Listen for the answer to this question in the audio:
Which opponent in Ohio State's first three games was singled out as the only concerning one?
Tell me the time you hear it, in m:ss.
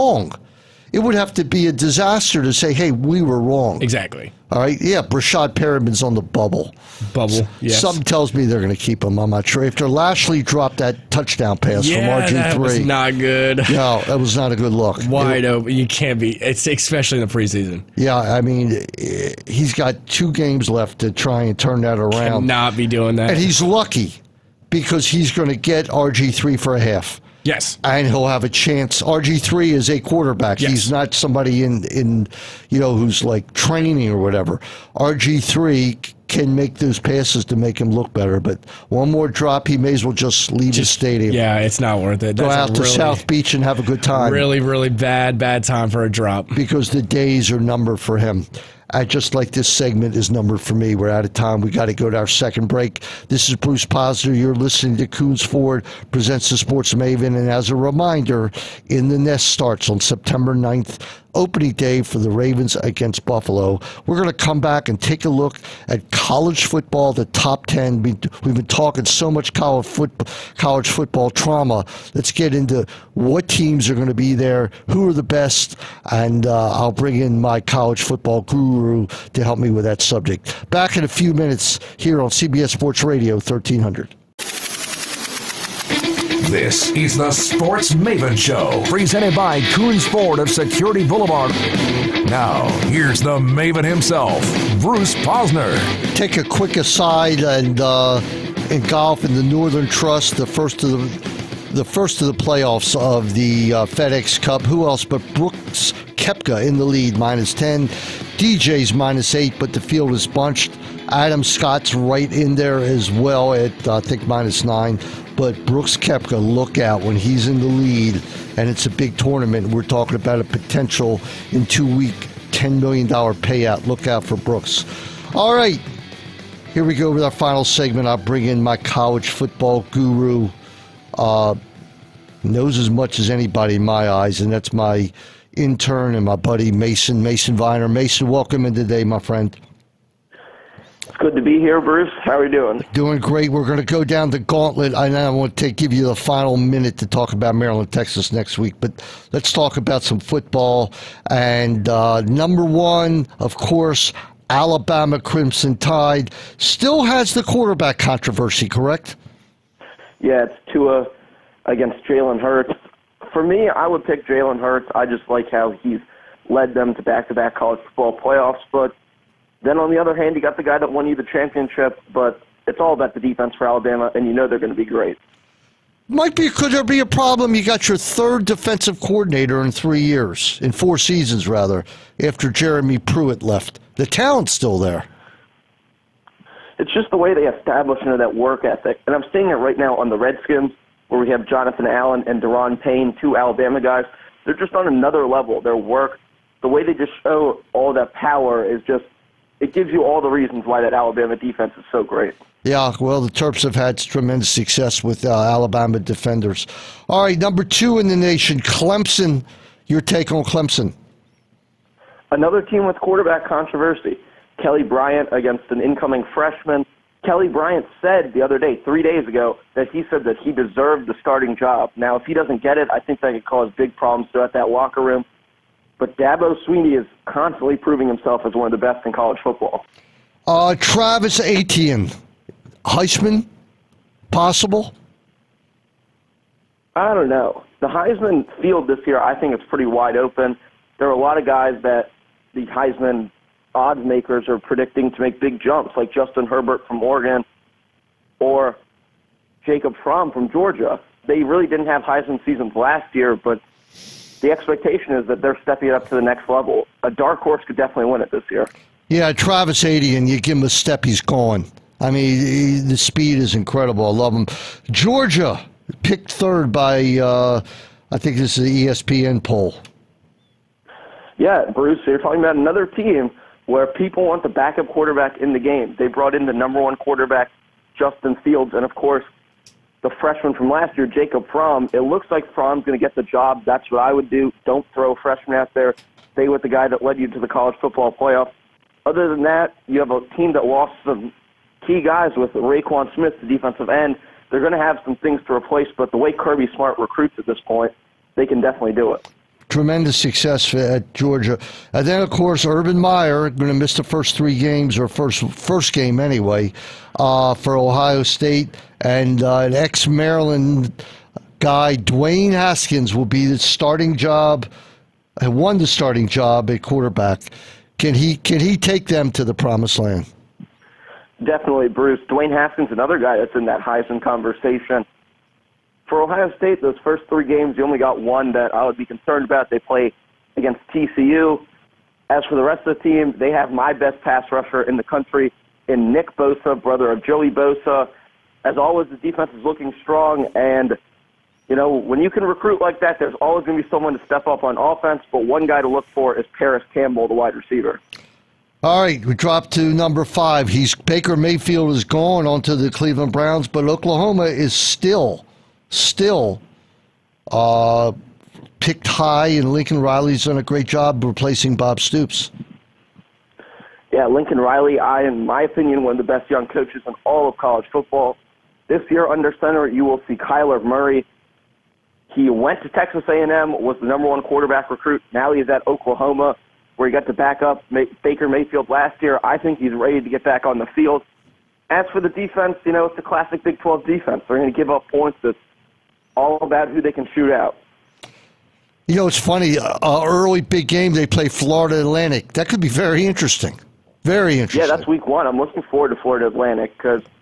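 5:30.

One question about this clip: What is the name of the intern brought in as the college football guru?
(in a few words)
Mason Viner.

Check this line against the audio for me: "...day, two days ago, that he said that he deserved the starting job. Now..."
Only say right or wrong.
wrong.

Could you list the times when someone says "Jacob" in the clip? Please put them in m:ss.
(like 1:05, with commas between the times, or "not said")
4:09, 4:41.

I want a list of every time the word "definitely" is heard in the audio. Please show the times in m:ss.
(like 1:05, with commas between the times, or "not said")
4:17, 4:58, 5:21.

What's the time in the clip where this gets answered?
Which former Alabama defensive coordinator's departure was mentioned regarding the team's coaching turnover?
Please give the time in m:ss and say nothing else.
3:02.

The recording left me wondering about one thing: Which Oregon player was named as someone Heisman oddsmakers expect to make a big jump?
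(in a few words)
Justin Herbert.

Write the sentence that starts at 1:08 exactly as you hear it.
We, have been talking so much college, college football trauma.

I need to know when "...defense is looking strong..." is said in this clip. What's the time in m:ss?
5:39.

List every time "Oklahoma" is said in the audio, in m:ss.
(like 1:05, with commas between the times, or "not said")
5:53, 6:15.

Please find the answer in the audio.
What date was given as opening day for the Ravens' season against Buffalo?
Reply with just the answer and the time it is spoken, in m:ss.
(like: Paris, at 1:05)
September 9th, at 0:59.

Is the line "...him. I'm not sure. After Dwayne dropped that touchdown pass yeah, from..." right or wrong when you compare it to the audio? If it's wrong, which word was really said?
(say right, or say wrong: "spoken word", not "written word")
wrong: "Lasley", not "Dwayne".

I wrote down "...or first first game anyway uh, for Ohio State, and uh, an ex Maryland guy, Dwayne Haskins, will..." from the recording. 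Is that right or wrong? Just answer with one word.
right.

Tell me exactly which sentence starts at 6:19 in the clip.
I think he's ready to get back on the field.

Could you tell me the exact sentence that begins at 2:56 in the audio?
Might be could there be a problem?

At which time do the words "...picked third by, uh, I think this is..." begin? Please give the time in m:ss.
4:26.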